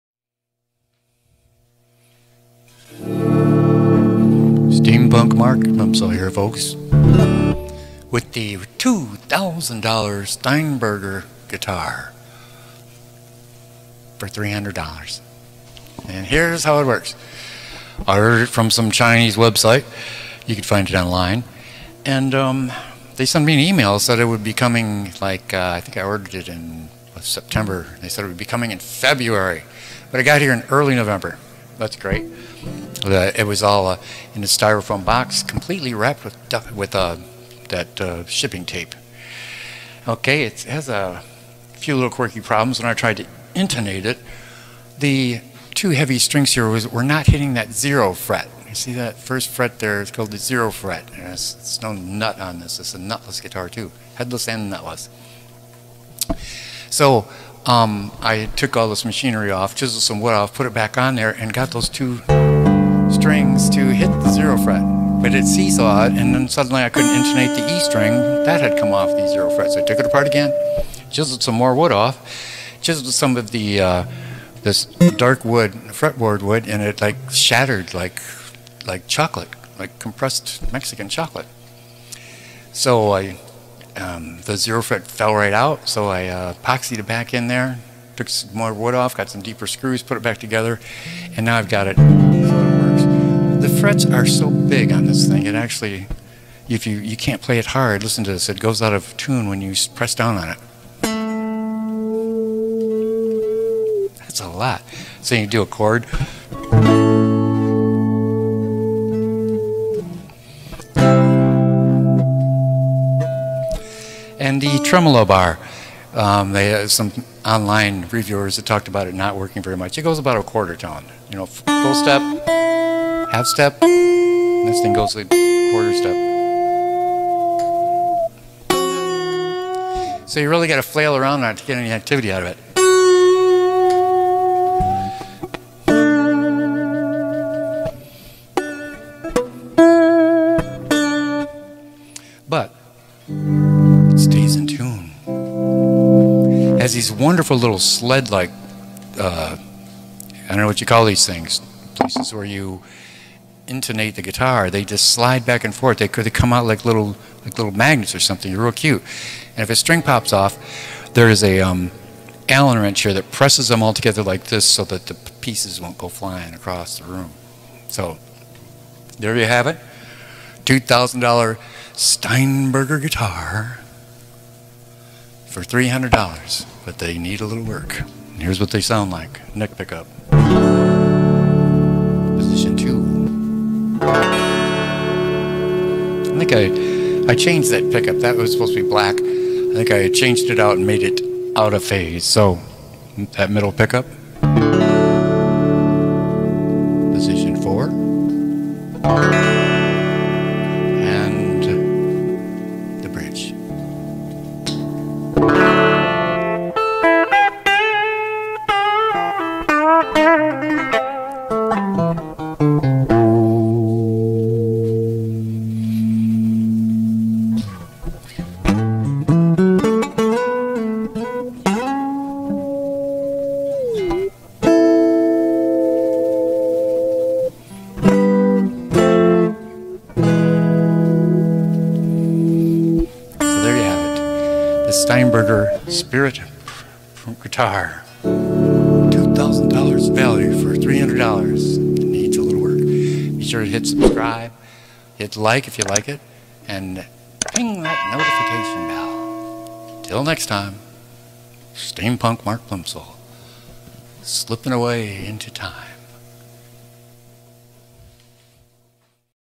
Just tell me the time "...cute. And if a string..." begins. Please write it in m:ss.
2:38.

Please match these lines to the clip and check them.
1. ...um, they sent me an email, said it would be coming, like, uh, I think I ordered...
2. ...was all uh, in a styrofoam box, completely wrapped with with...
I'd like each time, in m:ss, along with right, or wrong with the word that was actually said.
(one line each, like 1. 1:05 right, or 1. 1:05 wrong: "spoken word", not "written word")
1. 0:22 right
2. 0:33 right.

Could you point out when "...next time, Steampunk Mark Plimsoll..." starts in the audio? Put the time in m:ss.
4:10.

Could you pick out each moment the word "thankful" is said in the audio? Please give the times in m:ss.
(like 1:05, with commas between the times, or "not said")
not said.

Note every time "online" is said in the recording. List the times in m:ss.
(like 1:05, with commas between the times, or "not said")
0:20, 1:57.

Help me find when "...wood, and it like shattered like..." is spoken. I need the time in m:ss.
1:16.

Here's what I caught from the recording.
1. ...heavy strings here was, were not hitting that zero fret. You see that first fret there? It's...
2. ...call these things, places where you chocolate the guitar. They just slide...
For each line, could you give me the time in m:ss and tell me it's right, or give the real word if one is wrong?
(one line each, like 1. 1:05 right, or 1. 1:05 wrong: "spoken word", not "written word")
1. 0:45 right
2. 2:30 wrong: "intonate", not "chocolate".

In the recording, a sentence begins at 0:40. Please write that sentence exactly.
Okay, it has a few little quirky problems.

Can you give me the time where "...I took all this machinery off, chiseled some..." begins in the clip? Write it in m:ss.
0:58.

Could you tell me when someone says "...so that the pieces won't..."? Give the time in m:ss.
2:44.